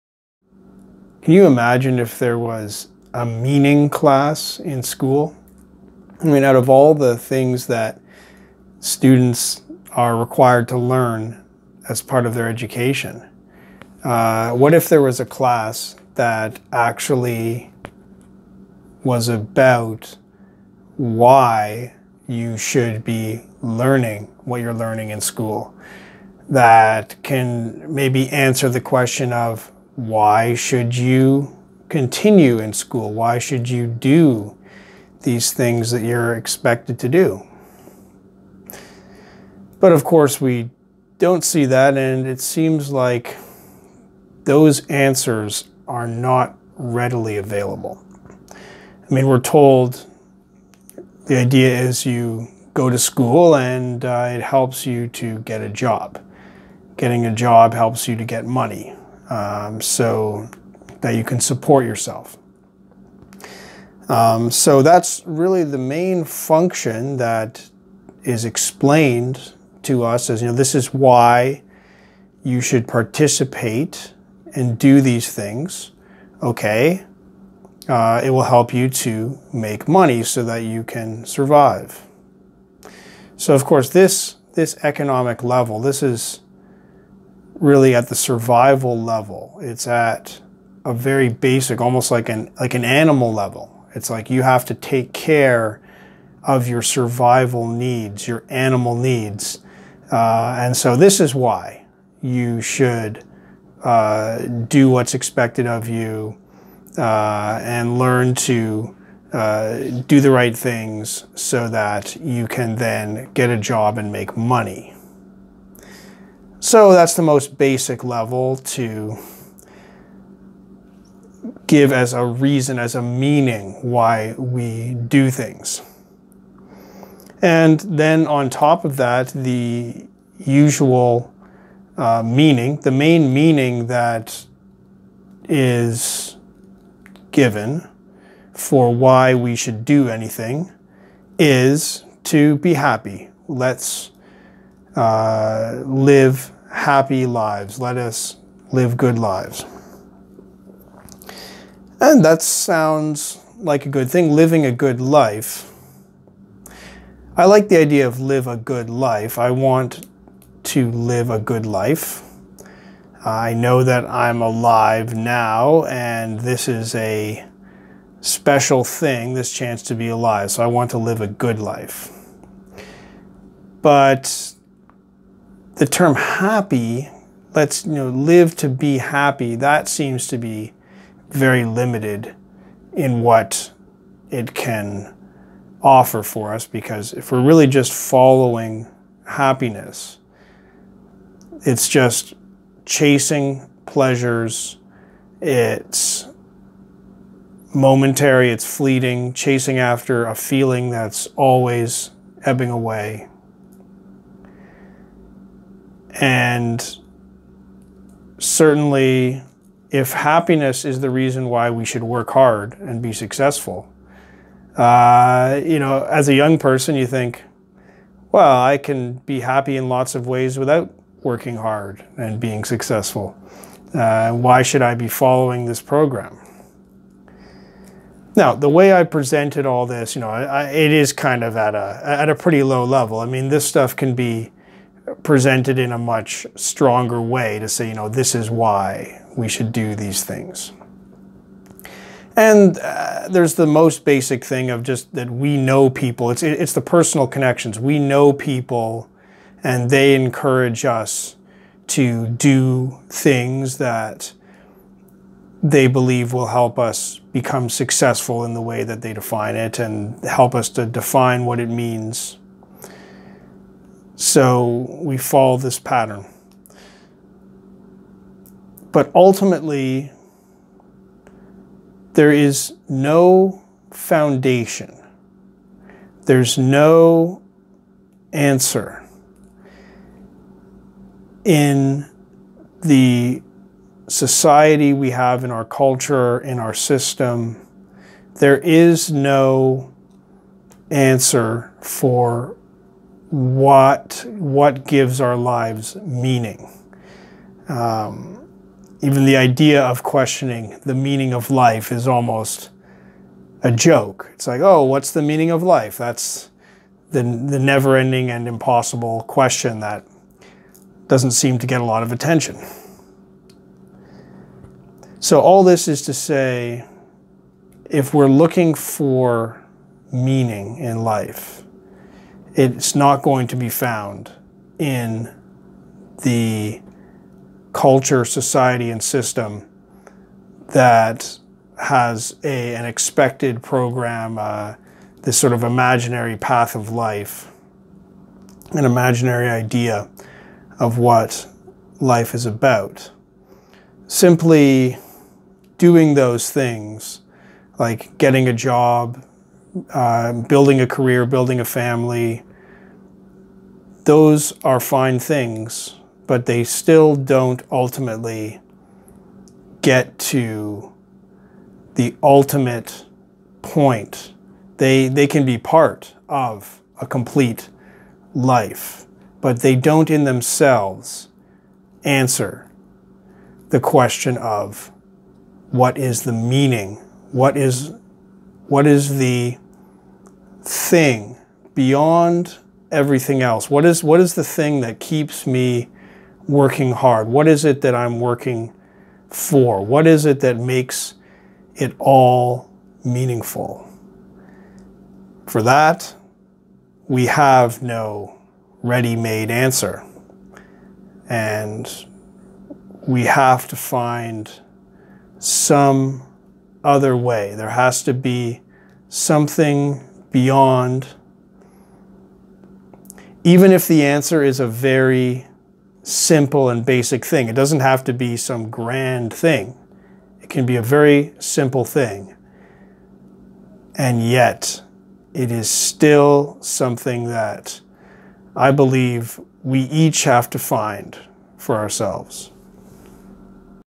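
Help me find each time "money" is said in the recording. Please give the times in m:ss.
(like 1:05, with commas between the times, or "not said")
0:58, 1:19, 1:54.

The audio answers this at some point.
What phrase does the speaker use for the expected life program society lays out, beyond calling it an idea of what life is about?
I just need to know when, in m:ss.
5:35.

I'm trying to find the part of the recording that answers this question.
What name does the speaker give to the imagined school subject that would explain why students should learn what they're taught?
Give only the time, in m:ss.
0:03.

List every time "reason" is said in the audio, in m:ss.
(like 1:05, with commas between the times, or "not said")
2:02, 3:31.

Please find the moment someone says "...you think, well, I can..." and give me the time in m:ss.
3:36.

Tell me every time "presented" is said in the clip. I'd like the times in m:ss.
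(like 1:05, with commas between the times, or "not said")
3:49, 3:55.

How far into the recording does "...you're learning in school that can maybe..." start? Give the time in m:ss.
0:24.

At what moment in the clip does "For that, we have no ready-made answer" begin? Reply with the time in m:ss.
6:35.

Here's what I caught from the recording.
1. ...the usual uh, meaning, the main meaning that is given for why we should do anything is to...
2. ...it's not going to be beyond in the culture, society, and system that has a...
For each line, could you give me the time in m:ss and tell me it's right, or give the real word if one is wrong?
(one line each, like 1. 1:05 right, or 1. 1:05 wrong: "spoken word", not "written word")
1. 2:09 right
2. 5:22 wrong: "found", not "beyond".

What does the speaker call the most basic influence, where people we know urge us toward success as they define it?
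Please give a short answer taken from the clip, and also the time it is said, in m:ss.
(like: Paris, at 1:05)
personal connections, at 4:06.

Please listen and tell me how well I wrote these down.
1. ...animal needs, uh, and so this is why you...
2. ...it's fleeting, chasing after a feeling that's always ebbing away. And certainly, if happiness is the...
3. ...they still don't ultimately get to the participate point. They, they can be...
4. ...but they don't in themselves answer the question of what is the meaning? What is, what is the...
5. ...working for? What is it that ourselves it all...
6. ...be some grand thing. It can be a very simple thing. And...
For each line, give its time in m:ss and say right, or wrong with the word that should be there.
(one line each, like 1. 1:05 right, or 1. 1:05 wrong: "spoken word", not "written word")
1. 1:38 right
2. 3:18 right
3. 5:56 wrong: "ultimate", not "participate"
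4. 6:09 right
5. 6:28 wrong: "makes", not "ourselves"
6. 6:58 right.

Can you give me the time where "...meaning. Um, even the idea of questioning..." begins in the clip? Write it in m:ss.
4:55.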